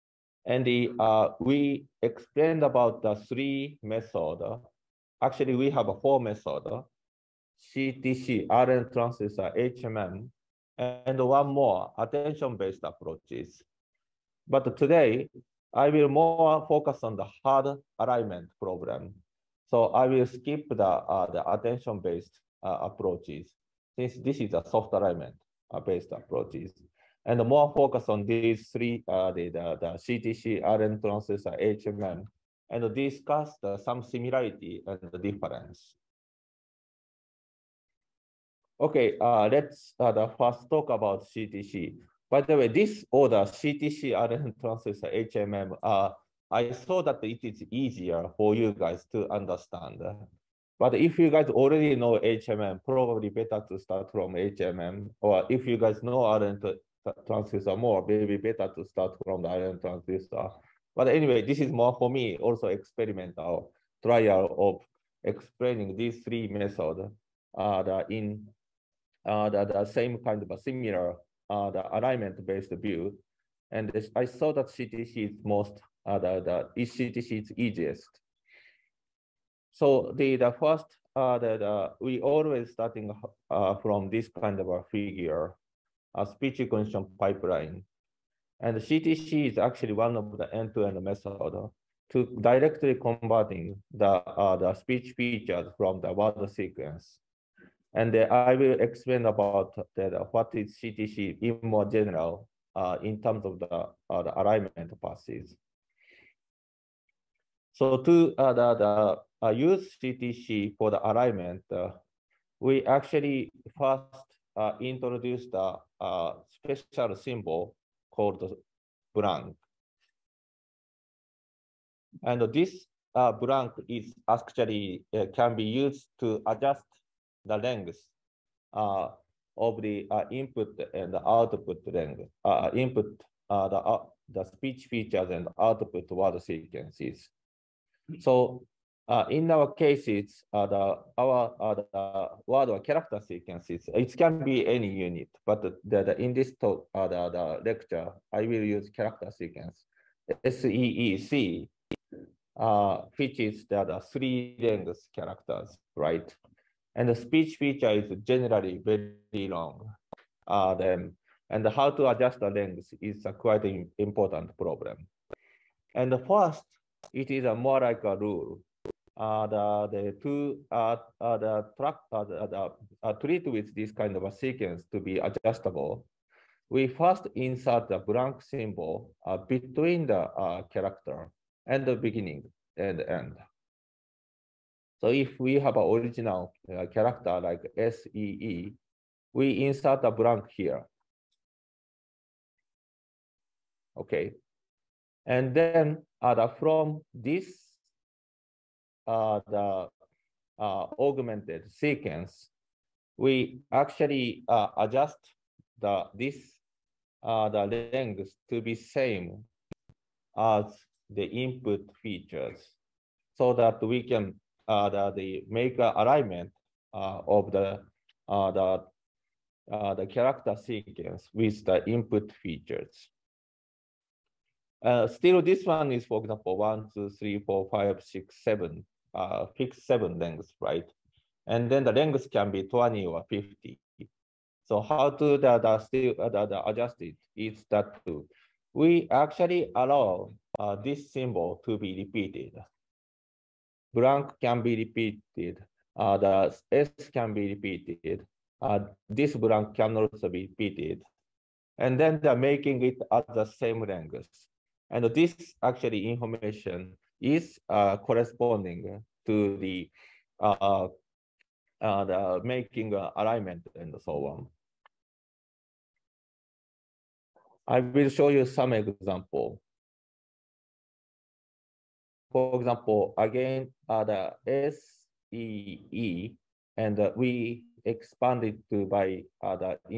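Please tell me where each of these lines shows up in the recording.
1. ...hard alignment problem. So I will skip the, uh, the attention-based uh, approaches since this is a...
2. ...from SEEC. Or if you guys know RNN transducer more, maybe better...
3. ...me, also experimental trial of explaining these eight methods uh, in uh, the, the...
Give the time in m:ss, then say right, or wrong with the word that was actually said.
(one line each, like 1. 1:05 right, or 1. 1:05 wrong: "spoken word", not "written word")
1. 0:17 right
2. 0:54 wrong: "HMM", not "SEEC"
3. 1:02 wrong: "three", not "eight".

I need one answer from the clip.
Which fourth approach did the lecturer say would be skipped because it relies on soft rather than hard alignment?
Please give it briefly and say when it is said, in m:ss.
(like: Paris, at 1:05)
Attention-based approaches, at 0:11.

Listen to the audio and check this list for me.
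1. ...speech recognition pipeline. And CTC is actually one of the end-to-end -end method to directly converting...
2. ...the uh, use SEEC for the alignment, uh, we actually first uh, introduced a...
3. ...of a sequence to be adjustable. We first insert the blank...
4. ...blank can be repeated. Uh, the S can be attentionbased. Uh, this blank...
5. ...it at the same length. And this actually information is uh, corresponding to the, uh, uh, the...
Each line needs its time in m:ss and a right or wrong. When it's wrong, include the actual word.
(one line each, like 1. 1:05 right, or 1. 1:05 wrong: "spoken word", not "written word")
1. 1:26 right
2. 1:48 wrong: "CTC", not "SEEC"
3. 2:54 right
4. 4:03 wrong: "repeated", not "attentionbased"
5. 4:12 right.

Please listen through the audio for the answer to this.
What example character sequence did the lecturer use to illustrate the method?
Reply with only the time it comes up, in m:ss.
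2:30.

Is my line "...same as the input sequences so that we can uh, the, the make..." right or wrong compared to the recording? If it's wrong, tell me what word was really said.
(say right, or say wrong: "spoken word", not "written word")
wrong: "features", not "sequences".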